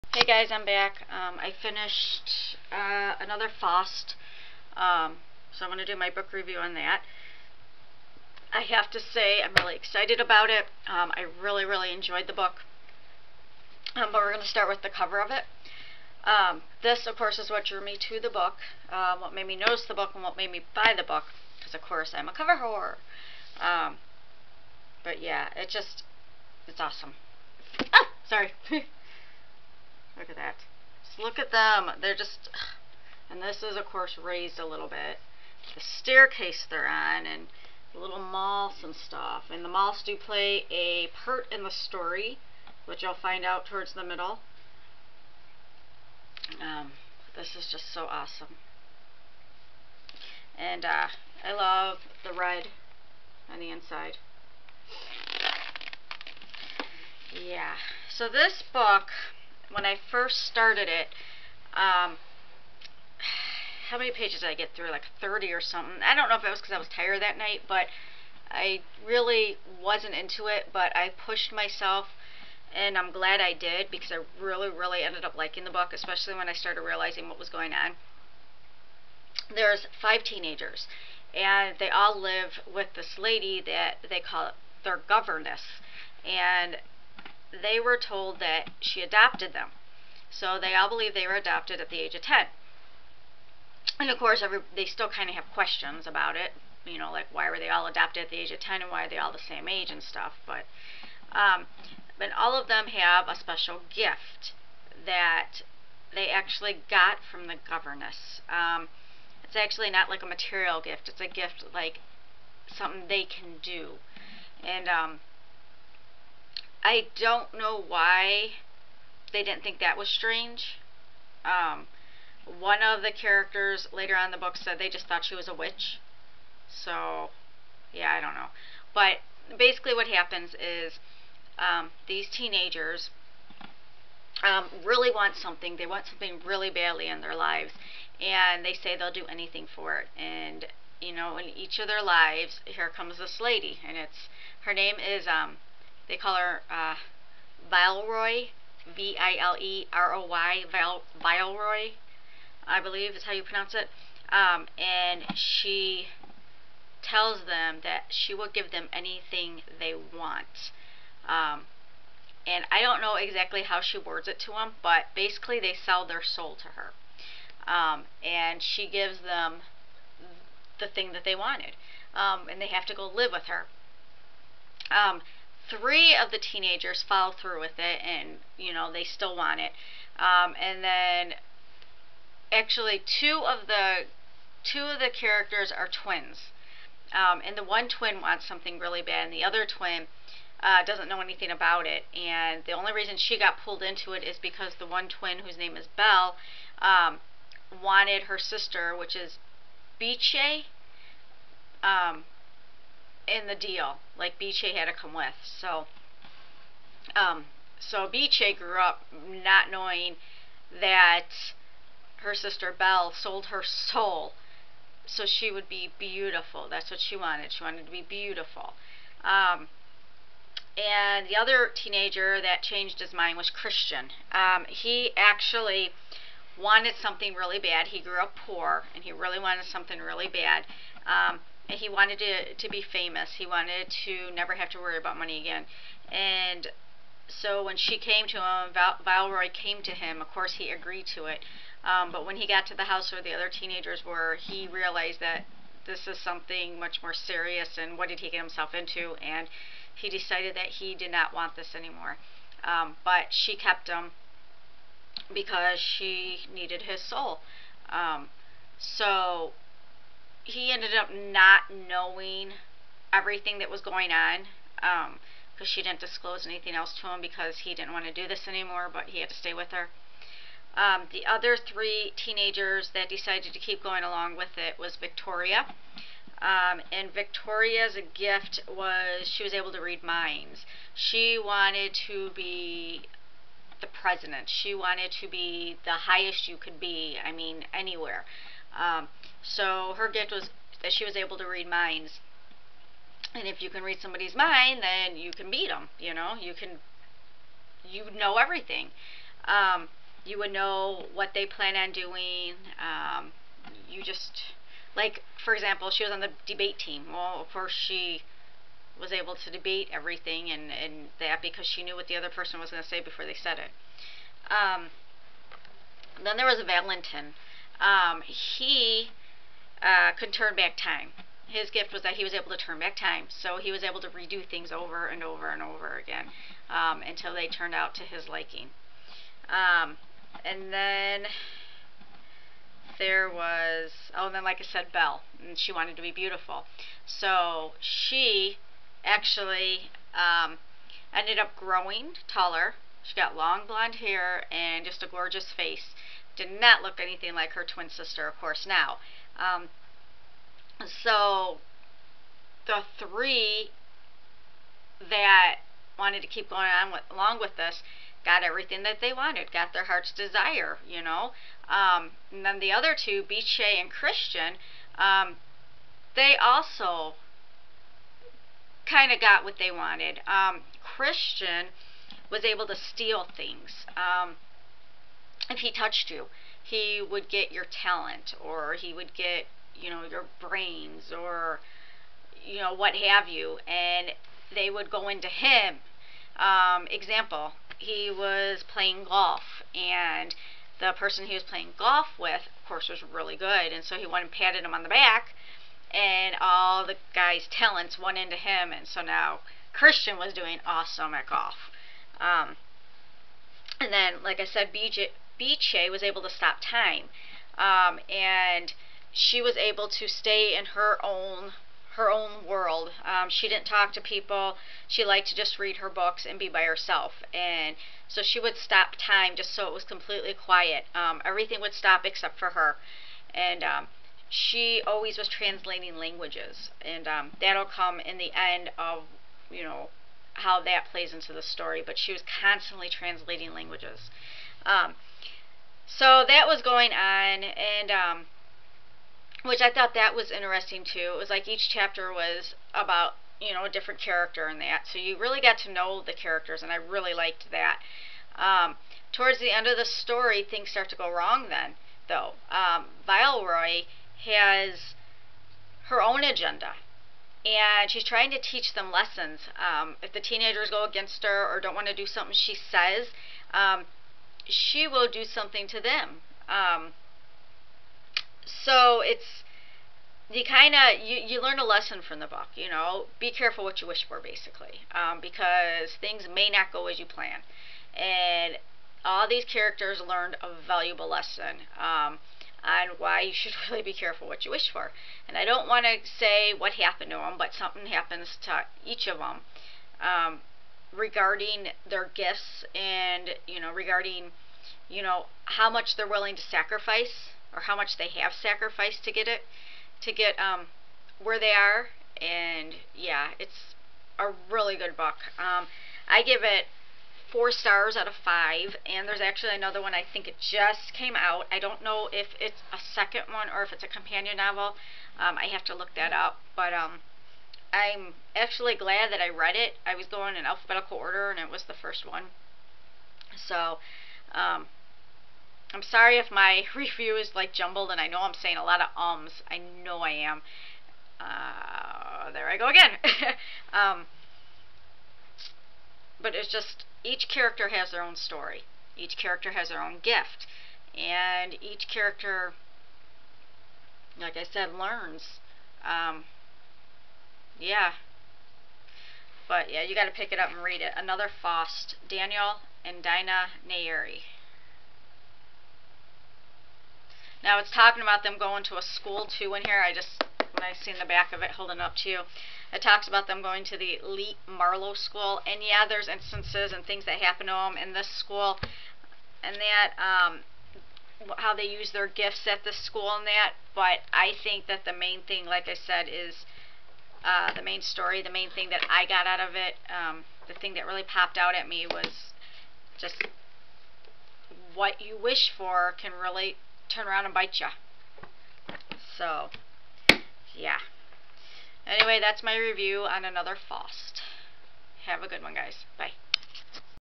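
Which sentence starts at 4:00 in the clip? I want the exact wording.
Of course, he agreed to it.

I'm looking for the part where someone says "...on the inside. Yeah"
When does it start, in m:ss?
0:53.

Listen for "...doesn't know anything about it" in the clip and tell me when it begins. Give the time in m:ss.
3:10.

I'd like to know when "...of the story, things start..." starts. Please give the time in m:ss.
7:29.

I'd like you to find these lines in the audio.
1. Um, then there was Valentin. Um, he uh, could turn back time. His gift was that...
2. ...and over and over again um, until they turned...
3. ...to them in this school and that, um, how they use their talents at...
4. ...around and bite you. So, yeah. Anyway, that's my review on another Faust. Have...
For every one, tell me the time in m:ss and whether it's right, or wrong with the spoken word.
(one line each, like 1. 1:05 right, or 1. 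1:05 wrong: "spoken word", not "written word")
1. 5:14 right
2. 5:25 right
3. 9:27 wrong: "gifts", not "talents"
4. 9:47 right.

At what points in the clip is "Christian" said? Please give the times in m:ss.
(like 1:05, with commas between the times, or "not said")
3:43, 6:03, 6:10, 6:39.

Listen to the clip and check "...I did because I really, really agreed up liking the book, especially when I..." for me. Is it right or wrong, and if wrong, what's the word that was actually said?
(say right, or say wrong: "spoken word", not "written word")
wrong: "ended", not "agreed".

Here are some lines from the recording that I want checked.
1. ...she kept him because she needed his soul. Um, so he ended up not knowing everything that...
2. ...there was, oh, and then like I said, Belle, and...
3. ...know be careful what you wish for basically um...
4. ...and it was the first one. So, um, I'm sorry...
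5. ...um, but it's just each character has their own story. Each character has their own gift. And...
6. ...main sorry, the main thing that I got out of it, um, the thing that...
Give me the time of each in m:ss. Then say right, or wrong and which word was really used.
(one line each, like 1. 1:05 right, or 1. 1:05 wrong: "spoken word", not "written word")
1. 4:13 right
2. 5:32 right
3. 7:52 right
4. 8:41 right
5. 8:53 right
6. 9:37 wrong: "story", not "sorry".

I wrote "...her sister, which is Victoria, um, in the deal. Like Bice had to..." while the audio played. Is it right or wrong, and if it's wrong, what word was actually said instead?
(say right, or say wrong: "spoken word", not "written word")
wrong: "Bice", not "Victoria".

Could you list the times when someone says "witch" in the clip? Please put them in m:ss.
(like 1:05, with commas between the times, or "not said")
2:05.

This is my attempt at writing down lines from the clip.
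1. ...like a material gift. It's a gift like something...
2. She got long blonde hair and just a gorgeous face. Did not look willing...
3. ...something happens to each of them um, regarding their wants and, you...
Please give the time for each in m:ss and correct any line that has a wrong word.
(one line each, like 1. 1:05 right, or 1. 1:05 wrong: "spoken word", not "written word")
1. 1:50 right
2. 5:43 wrong: "anything", not "willing"
3. 8:07 wrong: "gifts", not "wants".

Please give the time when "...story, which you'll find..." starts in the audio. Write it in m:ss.
0:41.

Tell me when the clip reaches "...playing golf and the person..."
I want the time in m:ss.
6:28.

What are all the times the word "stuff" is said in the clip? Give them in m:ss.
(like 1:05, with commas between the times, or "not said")
0:38, 1:40.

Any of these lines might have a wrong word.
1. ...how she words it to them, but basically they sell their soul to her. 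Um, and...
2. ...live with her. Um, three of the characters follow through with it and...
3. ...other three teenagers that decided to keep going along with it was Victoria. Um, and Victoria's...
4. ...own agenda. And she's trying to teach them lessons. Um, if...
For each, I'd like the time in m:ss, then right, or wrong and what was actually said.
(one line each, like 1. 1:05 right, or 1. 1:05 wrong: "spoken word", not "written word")
1. 2:43 right
2. 2:53 wrong: "teenagers", not "characters"
3. 4:31 right
4. 7:36 right.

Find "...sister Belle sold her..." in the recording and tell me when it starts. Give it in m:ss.
3:32.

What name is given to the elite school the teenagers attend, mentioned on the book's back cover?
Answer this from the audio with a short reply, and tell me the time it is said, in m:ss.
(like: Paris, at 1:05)
Marlowe, at 9:23.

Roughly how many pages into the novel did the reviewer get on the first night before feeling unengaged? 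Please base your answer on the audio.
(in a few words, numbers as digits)
30.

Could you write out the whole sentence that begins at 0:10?
Um, I really, really enjoyed the book.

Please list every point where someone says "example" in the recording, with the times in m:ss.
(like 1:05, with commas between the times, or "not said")
5:05, 6:26.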